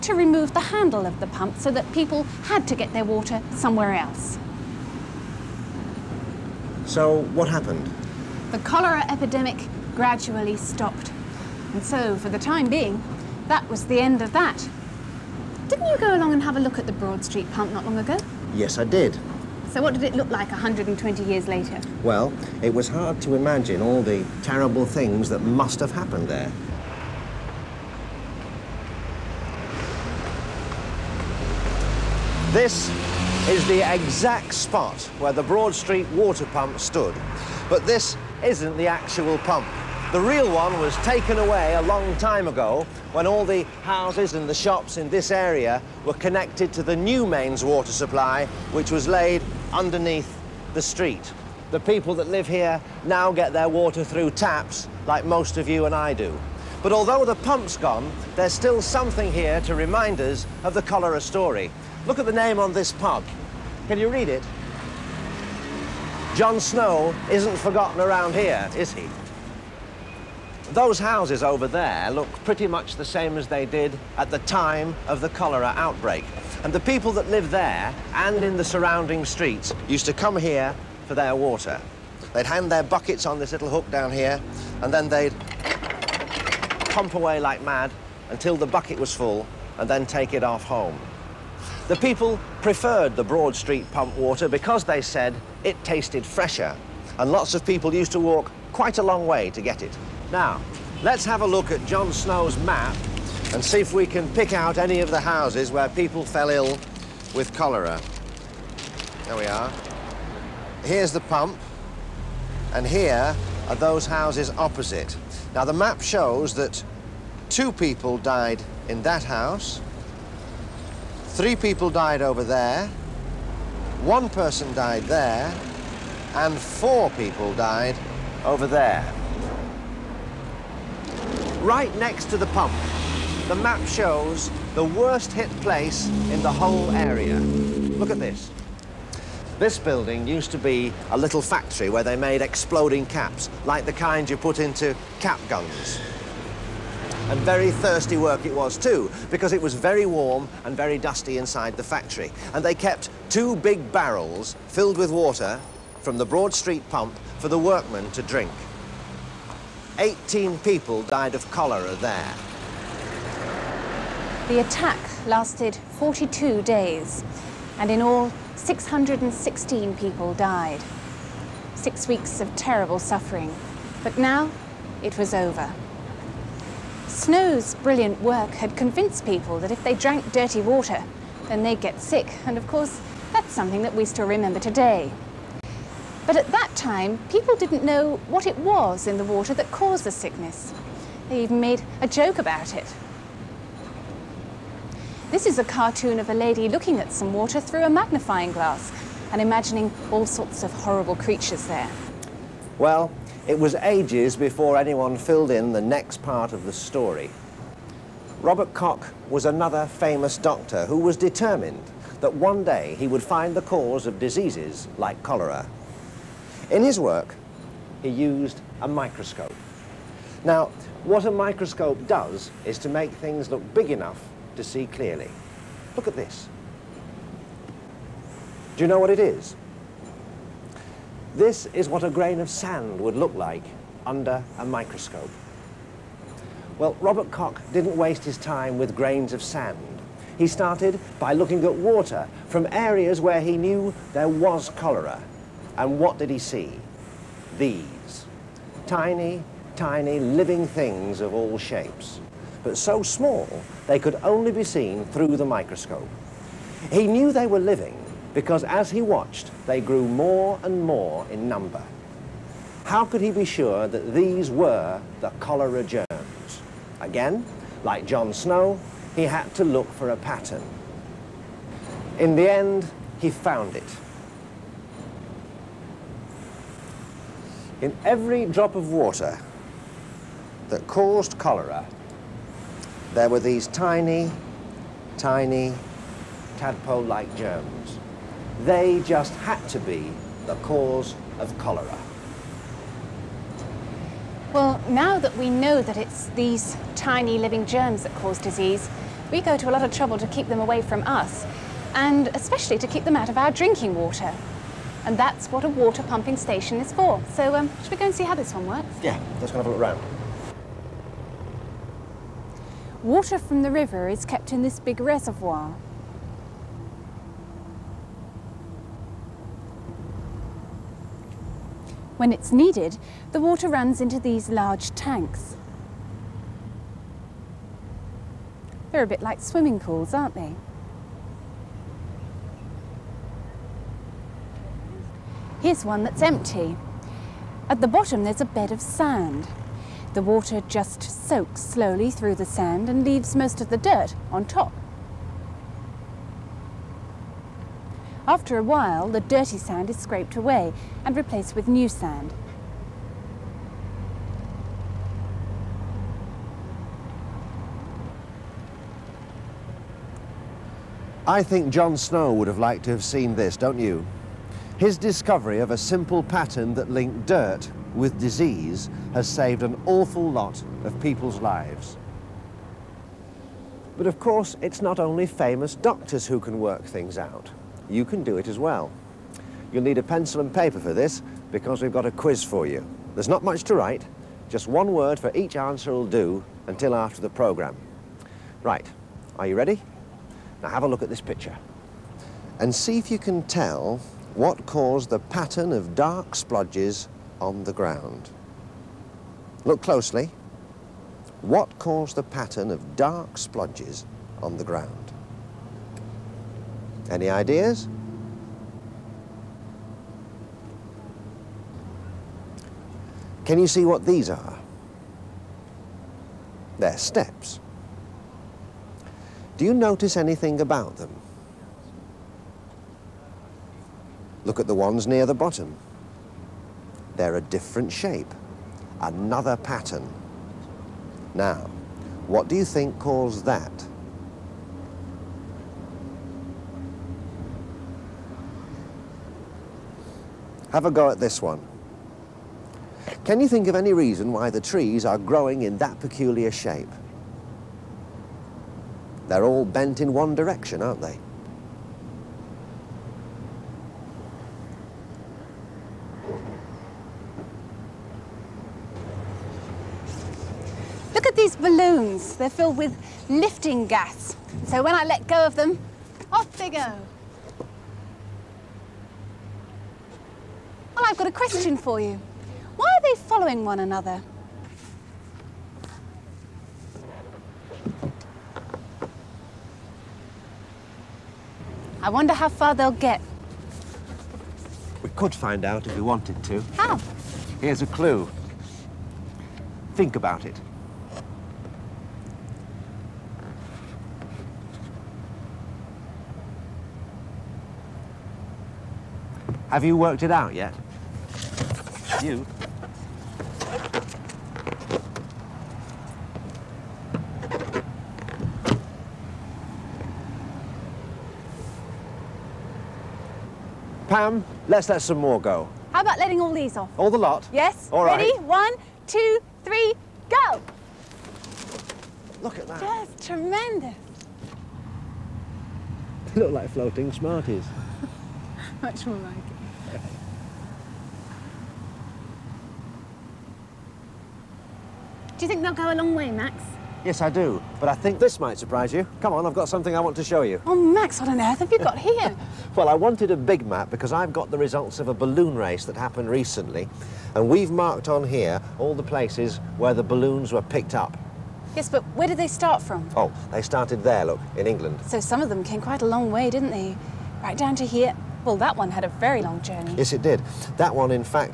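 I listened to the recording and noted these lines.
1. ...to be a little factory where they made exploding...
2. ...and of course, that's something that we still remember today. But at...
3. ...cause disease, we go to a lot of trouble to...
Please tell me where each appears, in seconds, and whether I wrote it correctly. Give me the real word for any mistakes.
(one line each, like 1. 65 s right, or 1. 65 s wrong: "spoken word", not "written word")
1. 140 s right
2. 182 s right
3. 298 s right.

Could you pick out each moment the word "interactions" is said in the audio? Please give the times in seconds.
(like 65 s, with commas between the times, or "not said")
not said.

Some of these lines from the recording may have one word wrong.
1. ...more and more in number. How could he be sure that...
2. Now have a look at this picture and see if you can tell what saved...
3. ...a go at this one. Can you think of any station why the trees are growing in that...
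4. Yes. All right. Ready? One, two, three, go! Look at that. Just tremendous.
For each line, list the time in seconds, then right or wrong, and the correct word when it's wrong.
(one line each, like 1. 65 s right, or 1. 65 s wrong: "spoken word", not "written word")
1. 260 s right
2. 390 s wrong: "caused", not "saved"
3. 440 s wrong: "reason", not "station"
4. 517 s right.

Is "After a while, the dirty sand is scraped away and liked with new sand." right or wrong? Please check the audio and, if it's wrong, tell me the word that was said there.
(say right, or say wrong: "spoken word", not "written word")
wrong: "replaced", not "liked".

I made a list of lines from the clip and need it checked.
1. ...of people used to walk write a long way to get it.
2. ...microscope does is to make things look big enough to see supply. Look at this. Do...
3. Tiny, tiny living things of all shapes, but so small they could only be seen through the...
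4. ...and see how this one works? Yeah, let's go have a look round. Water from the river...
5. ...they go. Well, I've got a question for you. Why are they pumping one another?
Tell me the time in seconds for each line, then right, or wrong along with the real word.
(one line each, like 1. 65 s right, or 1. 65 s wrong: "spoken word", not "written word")
1. 97 s wrong: "quite", not "write"
2. 221 s wrong: "clearly", not "supply"
3. 248 s right
4. 308 s right
5. 466 s wrong: "following", not "pumping".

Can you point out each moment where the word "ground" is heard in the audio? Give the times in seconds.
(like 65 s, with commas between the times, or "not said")
397 s, 404 s.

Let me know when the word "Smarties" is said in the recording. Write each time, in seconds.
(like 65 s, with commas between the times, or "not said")
527 s.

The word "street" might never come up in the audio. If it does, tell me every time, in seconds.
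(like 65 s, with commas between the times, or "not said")
17 s, 35 s, 50 s, 79 s, 93 s, 156 s.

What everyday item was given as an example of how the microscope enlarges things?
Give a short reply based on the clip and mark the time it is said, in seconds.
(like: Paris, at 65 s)
A grain of sand, at 232 s.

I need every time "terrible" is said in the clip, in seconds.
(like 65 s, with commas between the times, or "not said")
24 s, 172 s.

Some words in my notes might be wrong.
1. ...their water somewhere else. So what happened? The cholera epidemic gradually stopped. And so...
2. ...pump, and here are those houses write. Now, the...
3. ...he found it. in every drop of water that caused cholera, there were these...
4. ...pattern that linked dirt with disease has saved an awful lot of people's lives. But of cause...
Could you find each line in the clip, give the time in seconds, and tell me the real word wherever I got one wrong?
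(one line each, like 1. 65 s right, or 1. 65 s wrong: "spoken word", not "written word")
1. 2 s right
2. 111 s wrong: "opposite", not "write"
3. 273 s right
4. 366 s wrong: "course", not "cause".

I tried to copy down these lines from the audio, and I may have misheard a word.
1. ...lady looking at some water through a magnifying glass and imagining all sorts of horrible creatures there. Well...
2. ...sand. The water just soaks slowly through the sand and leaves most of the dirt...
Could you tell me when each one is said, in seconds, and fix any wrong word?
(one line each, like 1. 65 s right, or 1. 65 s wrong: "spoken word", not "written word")
1. 196 s right
2. 338 s right.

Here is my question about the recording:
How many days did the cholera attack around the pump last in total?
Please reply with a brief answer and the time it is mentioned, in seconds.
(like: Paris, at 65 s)
42, at 165 s.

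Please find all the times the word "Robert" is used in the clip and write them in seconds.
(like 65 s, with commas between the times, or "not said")
208 s, 237 s.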